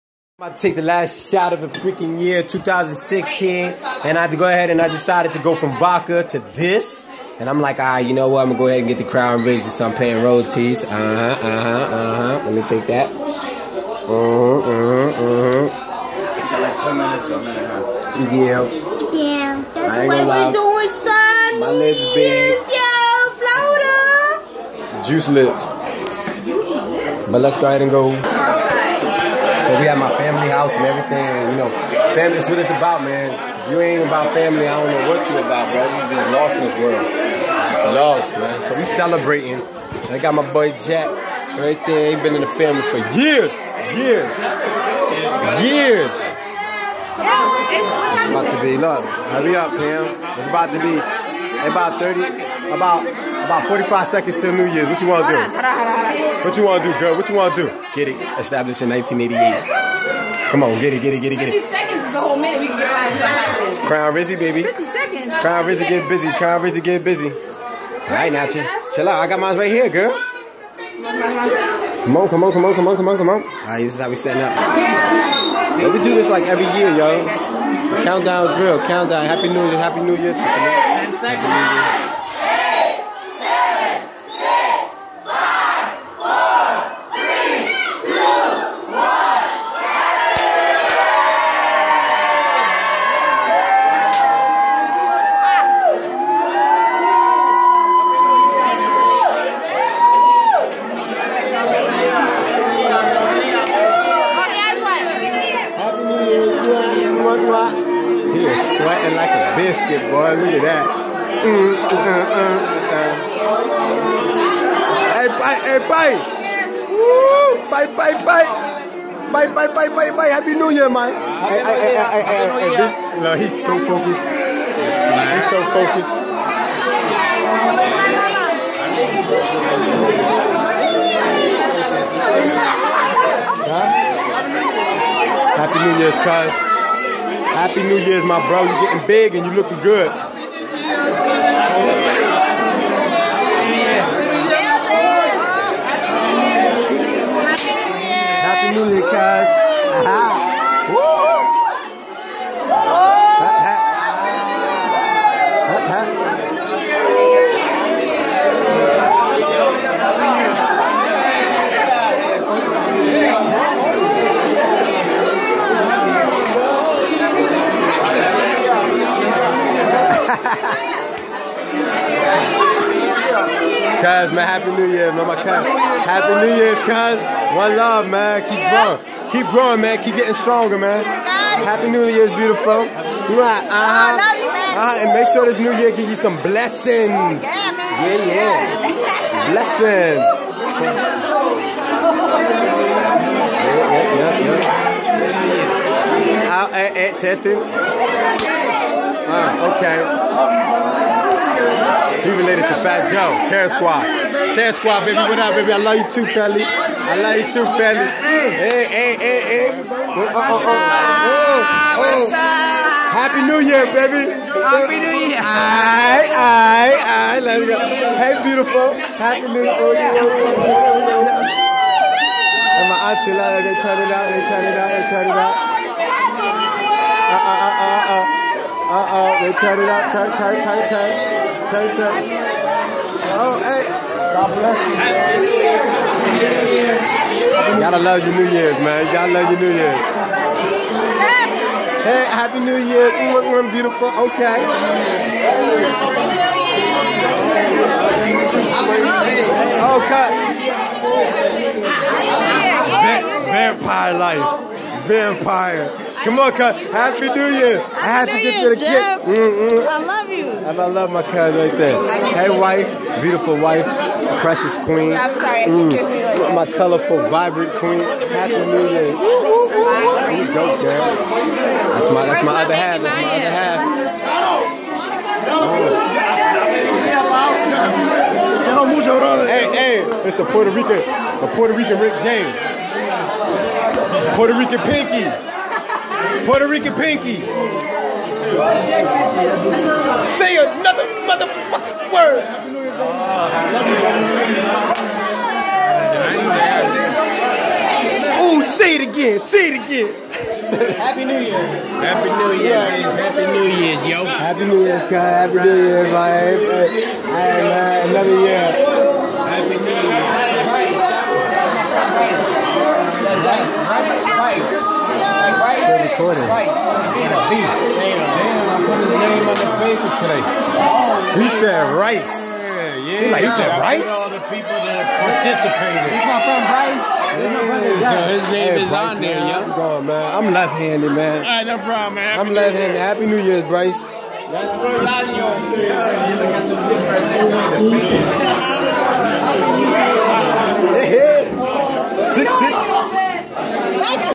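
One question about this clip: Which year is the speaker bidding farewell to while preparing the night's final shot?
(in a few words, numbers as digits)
2016.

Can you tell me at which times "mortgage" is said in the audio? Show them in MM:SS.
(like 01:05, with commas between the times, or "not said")
not said.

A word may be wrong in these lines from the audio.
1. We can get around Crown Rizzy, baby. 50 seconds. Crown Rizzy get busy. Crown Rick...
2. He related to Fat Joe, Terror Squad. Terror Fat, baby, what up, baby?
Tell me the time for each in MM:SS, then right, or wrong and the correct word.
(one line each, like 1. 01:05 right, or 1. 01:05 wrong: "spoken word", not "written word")
1. 01:02 wrong: "Rizzy", not "Rick"
2. 03:22 wrong: "Squad", not "Fat".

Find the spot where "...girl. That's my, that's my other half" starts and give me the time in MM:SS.
04:30.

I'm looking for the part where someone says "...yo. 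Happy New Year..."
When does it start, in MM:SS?
05:04.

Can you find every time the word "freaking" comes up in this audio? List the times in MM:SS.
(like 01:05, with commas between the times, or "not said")
00:01.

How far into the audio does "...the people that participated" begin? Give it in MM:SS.
05:24.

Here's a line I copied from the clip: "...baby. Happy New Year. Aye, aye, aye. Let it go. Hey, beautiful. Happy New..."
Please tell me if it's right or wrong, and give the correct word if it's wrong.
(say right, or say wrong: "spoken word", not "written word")
right.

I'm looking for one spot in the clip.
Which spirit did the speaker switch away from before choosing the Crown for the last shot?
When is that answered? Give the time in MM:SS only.
00:05.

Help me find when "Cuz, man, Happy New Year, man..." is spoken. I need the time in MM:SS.
02:54.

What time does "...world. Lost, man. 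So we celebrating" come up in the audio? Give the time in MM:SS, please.
00:36.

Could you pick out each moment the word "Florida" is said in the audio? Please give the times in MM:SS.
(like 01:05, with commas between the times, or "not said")
00:24.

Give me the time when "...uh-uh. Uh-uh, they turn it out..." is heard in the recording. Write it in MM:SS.
03:48.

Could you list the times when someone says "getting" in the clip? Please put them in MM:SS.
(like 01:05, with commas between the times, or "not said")
02:18, 03:00.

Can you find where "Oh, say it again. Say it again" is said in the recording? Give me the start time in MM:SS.
04:58.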